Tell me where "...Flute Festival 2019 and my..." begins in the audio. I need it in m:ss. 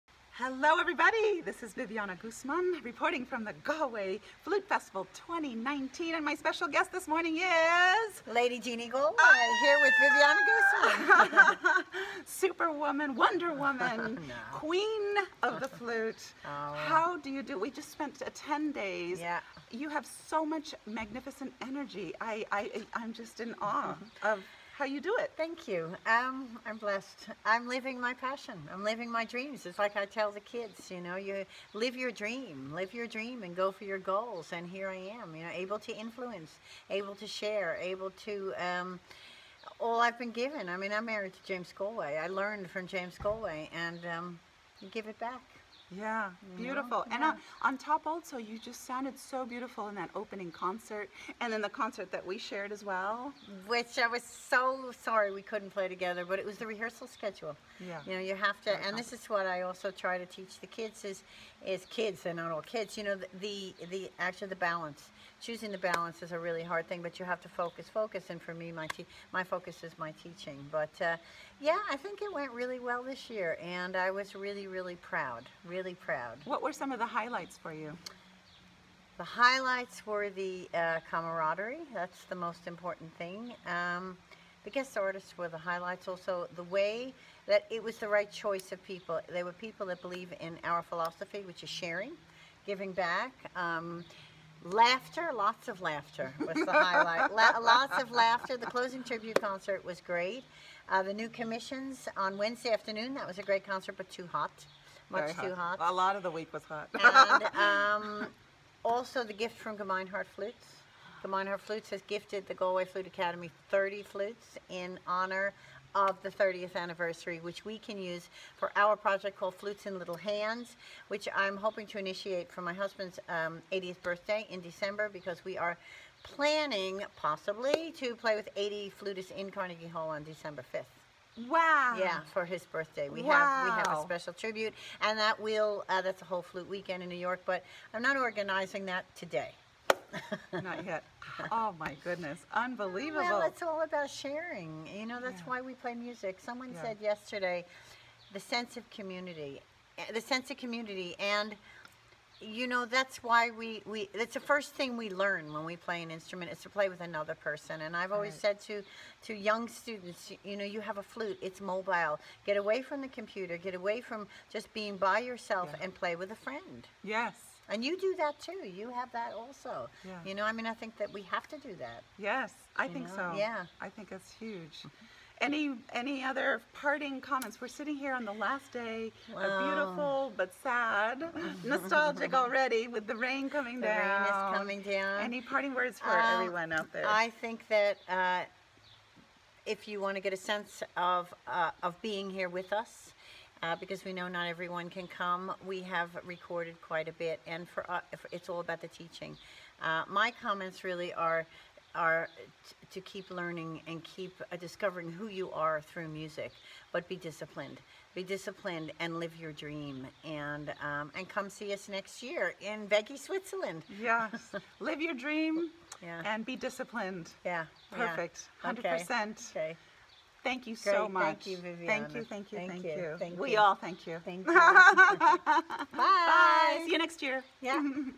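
0:04.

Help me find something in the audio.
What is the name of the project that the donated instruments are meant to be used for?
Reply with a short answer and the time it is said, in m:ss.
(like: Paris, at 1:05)
Flutes in Little Hands, at 1:59.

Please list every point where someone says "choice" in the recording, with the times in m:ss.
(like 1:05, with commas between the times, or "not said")
1:28.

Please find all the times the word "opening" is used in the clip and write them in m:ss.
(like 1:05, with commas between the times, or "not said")
0:50.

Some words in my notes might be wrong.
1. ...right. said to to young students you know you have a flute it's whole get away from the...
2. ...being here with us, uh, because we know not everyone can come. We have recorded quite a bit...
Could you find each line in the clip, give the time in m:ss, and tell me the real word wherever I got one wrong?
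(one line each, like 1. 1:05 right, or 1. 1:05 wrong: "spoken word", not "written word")
1. 2:38 wrong: "mobile", not "whole"
2. 3:12 right.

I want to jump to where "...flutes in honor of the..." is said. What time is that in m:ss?
1:54.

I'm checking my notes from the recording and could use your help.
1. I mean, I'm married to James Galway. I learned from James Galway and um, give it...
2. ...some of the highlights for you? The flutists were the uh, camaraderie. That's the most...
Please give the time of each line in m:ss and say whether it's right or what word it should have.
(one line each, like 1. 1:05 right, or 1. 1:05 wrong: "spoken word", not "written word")
1. 0:40 right
2. 1:16 wrong: "highlights", not "flutists".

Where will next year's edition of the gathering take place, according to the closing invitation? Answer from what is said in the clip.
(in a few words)
Weggis, Switzerland.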